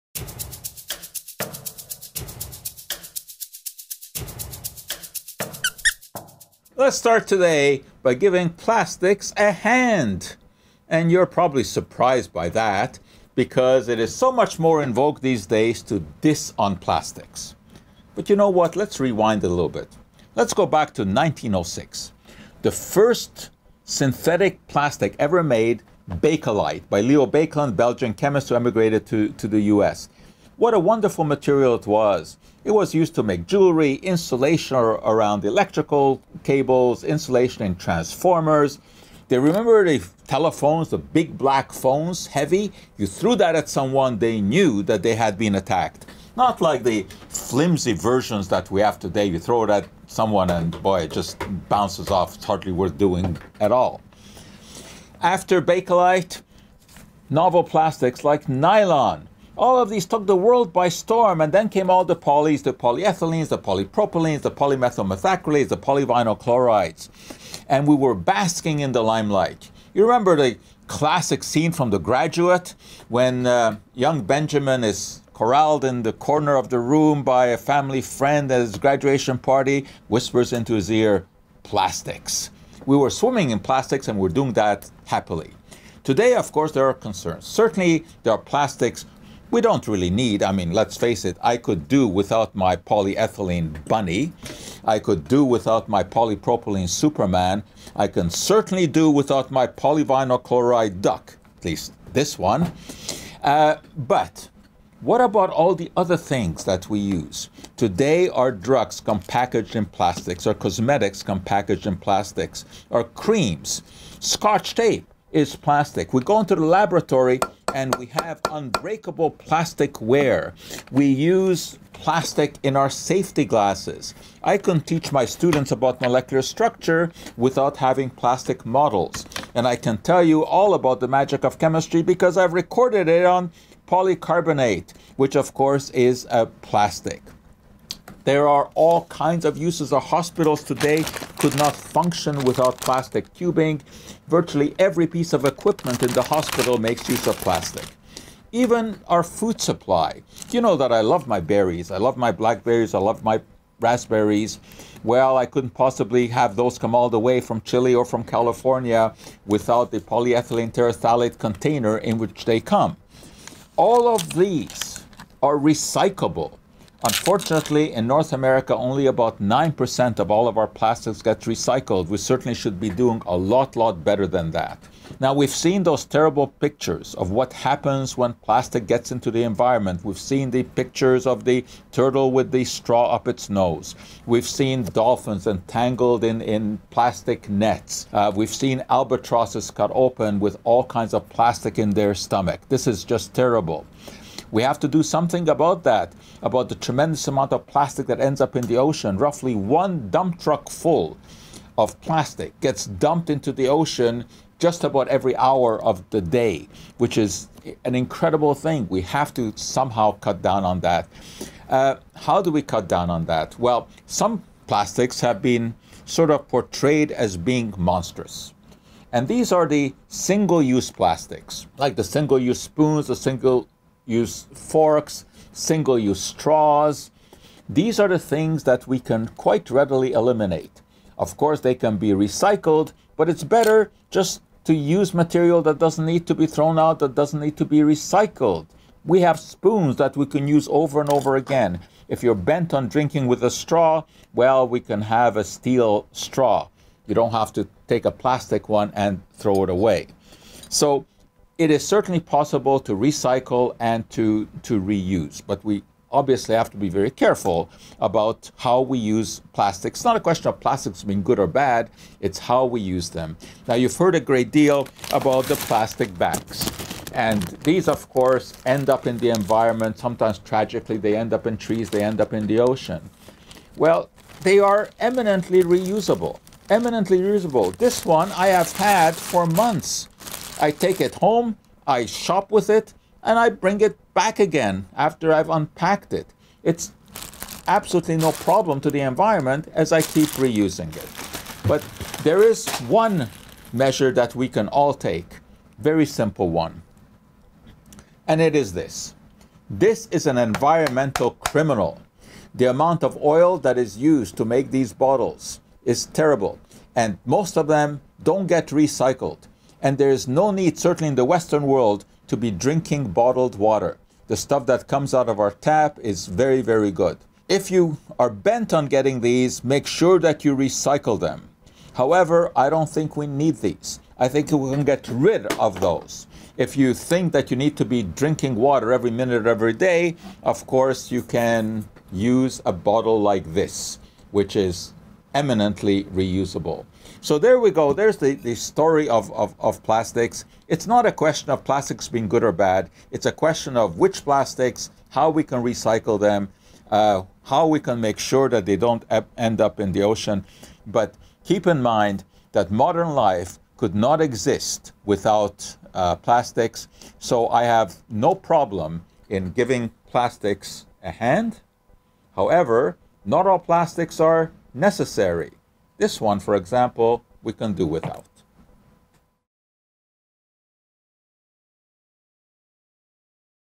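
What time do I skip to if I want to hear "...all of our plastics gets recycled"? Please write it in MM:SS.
02:50.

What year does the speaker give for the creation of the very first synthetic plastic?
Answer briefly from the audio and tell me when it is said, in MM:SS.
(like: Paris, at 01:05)
1906, at 00:21.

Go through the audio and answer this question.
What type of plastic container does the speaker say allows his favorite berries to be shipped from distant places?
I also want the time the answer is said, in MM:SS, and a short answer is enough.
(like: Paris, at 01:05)
polyethylene terephthalate, at 02:39.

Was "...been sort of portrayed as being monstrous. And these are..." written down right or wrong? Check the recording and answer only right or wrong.
right.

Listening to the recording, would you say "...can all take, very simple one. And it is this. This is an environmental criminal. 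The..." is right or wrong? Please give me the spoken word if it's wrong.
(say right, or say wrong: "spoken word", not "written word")
right.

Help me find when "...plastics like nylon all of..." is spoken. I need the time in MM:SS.
00:57.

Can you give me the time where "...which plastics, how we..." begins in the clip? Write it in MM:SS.
05:43.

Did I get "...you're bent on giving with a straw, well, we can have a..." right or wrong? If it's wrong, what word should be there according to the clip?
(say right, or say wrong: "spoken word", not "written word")
wrong: "drinking", not "giving".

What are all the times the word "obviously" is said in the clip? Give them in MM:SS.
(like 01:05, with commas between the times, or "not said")
04:16.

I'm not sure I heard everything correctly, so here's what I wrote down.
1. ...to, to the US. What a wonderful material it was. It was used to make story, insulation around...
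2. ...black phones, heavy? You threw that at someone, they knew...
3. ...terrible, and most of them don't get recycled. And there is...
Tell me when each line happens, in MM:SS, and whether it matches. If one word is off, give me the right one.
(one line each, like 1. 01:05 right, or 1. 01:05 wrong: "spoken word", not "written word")
1. 00:29 wrong: "jewelry", not "story"
2. 00:41 right
3. 05:06 right.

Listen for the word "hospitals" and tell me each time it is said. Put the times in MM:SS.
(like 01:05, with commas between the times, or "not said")
02:20, 02:26.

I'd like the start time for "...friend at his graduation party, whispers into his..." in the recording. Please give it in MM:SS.
01:18.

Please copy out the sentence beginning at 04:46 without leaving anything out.
It's absolutely no problem to the environment as I keep reusing it.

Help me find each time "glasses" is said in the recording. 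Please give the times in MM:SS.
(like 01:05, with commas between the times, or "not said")
02:03.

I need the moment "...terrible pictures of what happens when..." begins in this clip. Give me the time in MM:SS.
02:56.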